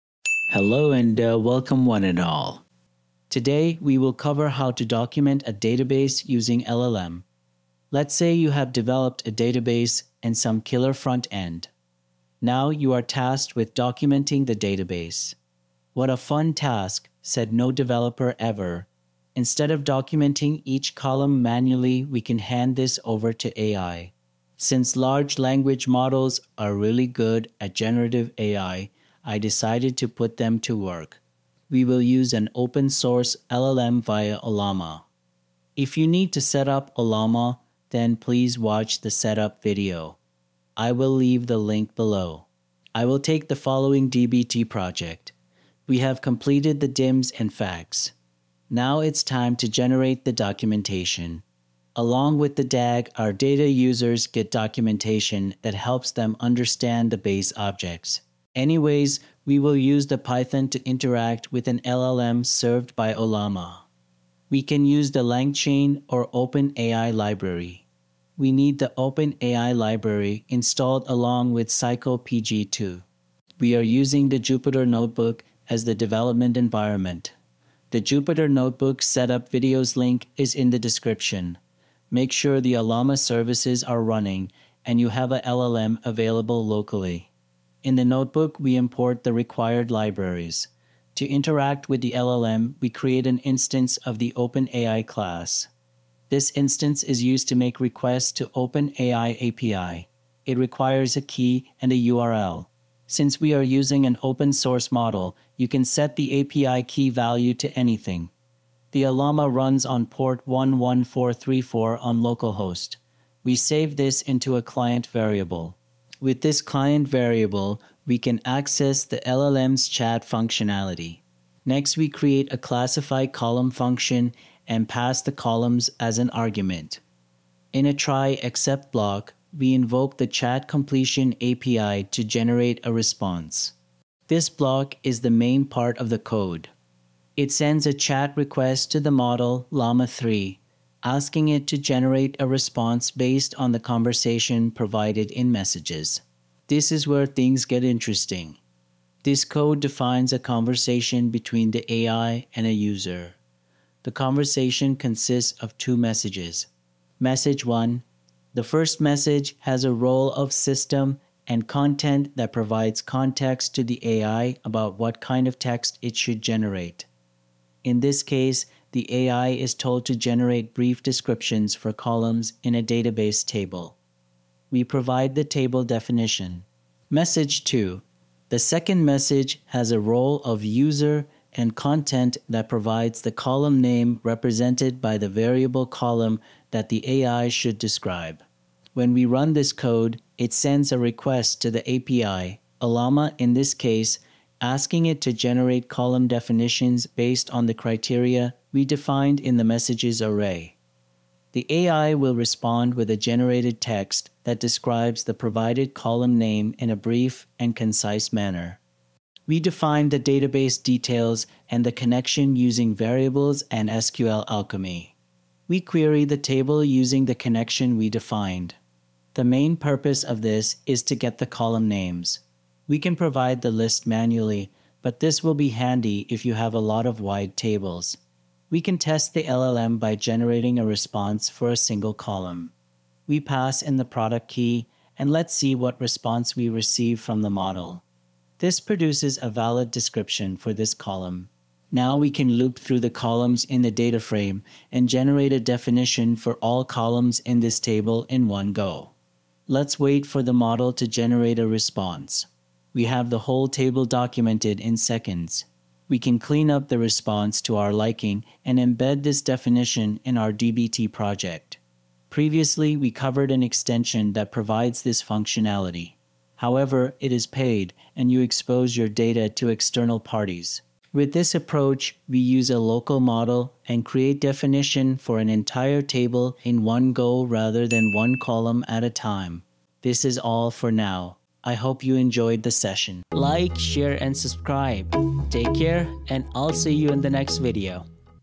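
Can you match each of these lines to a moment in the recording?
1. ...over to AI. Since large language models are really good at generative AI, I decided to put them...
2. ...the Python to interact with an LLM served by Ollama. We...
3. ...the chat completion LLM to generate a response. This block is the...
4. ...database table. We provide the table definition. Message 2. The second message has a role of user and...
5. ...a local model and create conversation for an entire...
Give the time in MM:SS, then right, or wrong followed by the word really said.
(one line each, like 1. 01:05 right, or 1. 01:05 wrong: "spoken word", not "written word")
1. 00:23 right
2. 01:00 right
3. 02:10 wrong: "API", not "LLM"
4. 02:52 right
5. 04:32 wrong: "definition", not "conversation".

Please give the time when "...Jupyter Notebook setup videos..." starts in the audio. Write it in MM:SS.
01:18.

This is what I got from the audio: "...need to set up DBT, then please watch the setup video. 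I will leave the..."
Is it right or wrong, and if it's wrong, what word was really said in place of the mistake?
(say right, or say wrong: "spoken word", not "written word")
wrong: "Ollama", not "DBT".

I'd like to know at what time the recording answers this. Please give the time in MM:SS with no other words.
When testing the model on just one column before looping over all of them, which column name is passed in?
03:54.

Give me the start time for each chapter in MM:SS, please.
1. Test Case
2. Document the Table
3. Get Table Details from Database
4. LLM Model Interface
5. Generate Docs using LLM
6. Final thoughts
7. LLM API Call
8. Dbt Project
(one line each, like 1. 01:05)
1. 03:48
2. 04:02
3. 03:31
4. 01:31
5. 02:16
6. 04:23
7. 02:01
8. 00:42.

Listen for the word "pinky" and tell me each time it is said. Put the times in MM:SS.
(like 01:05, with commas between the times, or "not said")
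not said.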